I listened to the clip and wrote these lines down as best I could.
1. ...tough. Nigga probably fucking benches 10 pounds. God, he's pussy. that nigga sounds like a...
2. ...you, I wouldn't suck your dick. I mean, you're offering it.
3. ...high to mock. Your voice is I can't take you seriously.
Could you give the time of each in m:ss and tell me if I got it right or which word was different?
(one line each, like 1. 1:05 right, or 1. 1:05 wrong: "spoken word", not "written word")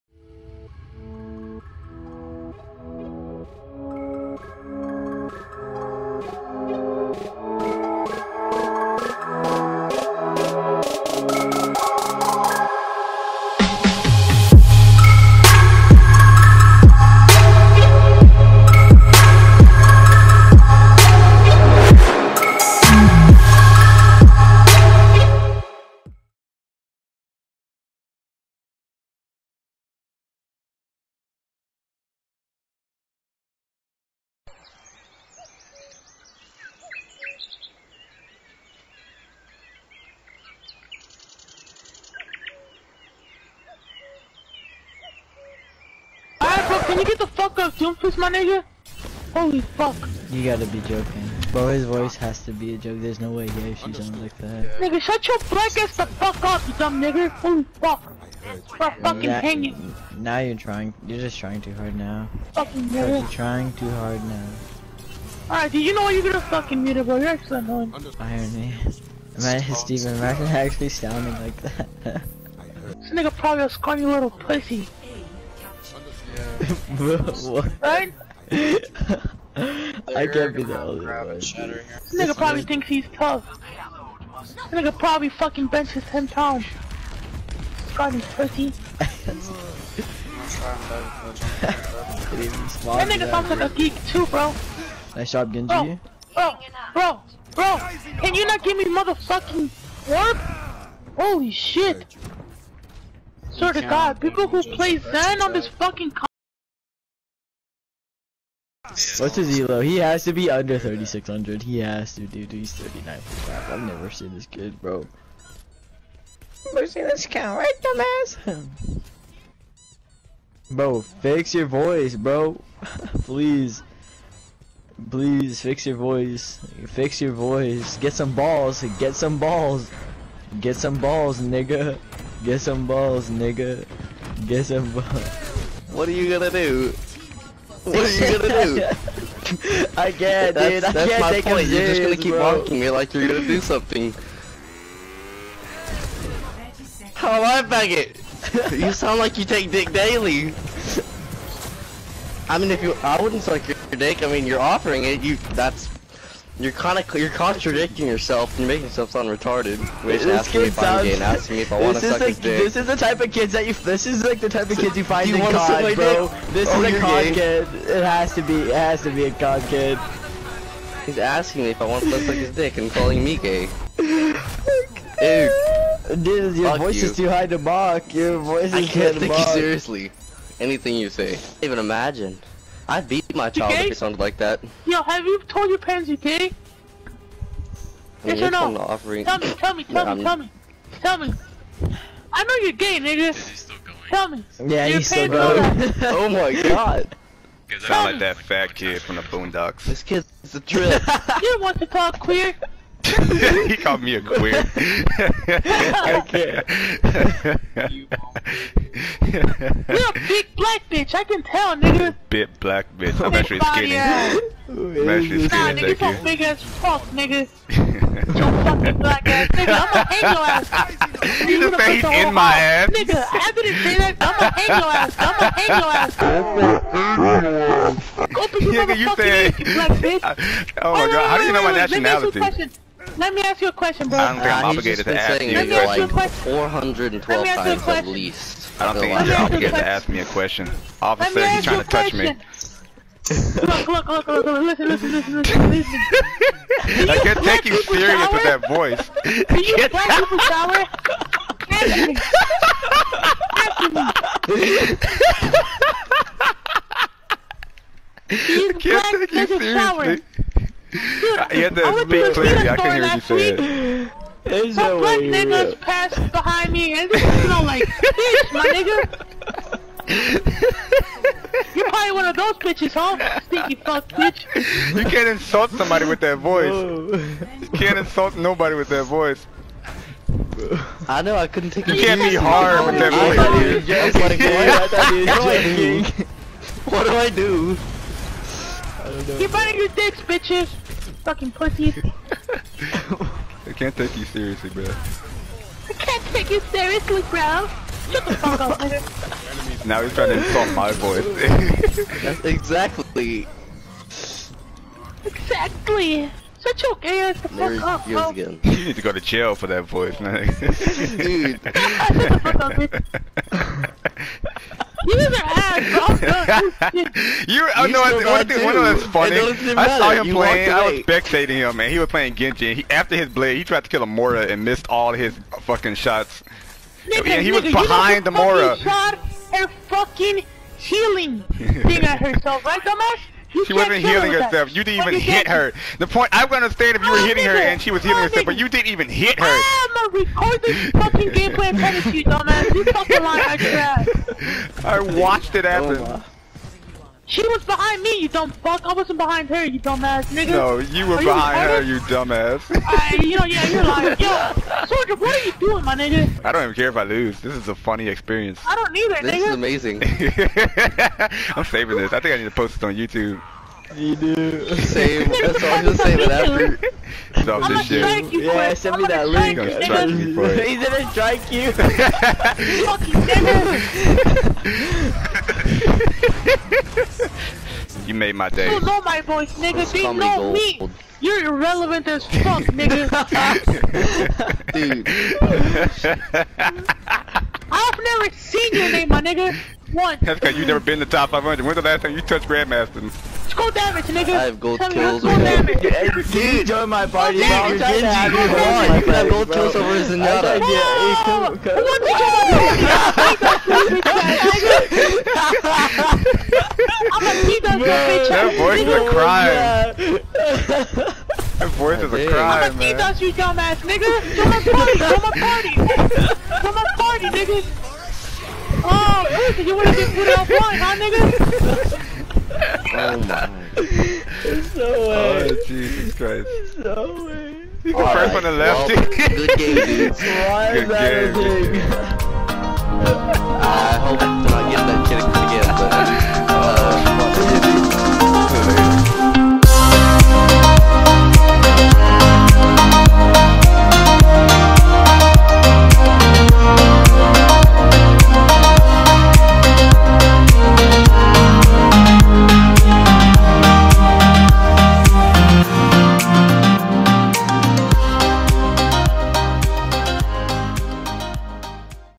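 1. 1:23 right
2. 2:32 right
3. 2:57 right.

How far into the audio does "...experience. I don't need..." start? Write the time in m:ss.
5:58.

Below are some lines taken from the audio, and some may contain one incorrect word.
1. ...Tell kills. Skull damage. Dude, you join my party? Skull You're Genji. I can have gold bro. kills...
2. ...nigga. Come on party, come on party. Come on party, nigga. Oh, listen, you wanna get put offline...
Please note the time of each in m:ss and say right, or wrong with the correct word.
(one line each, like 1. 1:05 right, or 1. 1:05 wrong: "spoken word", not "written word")
1. 6:34 right
2. 6:53 right.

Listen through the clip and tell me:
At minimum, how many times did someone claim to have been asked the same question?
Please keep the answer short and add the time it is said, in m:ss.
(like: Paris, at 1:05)
412, at 3:56.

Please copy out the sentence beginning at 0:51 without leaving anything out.
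his voice has to be a joke.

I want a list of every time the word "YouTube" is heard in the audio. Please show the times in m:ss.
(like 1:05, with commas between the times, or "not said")
6:02.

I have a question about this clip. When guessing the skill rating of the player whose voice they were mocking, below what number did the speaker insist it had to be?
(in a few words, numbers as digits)
3600.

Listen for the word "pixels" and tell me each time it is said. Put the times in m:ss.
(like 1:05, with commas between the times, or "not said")
not said.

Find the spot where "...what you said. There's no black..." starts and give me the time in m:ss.
4:23.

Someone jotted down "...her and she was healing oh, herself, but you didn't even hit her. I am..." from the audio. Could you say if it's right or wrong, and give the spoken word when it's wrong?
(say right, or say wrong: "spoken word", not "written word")
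right.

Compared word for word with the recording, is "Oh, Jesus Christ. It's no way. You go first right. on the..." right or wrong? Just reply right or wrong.
right.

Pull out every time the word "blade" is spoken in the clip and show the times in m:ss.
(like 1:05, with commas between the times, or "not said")
5:23.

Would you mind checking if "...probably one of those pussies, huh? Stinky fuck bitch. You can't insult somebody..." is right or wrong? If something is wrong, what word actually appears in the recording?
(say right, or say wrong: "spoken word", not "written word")
wrong: "bitches", not "pussies".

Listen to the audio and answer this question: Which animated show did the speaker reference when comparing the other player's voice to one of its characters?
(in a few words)
The Boondocks.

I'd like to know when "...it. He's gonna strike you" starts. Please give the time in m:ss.
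6:10.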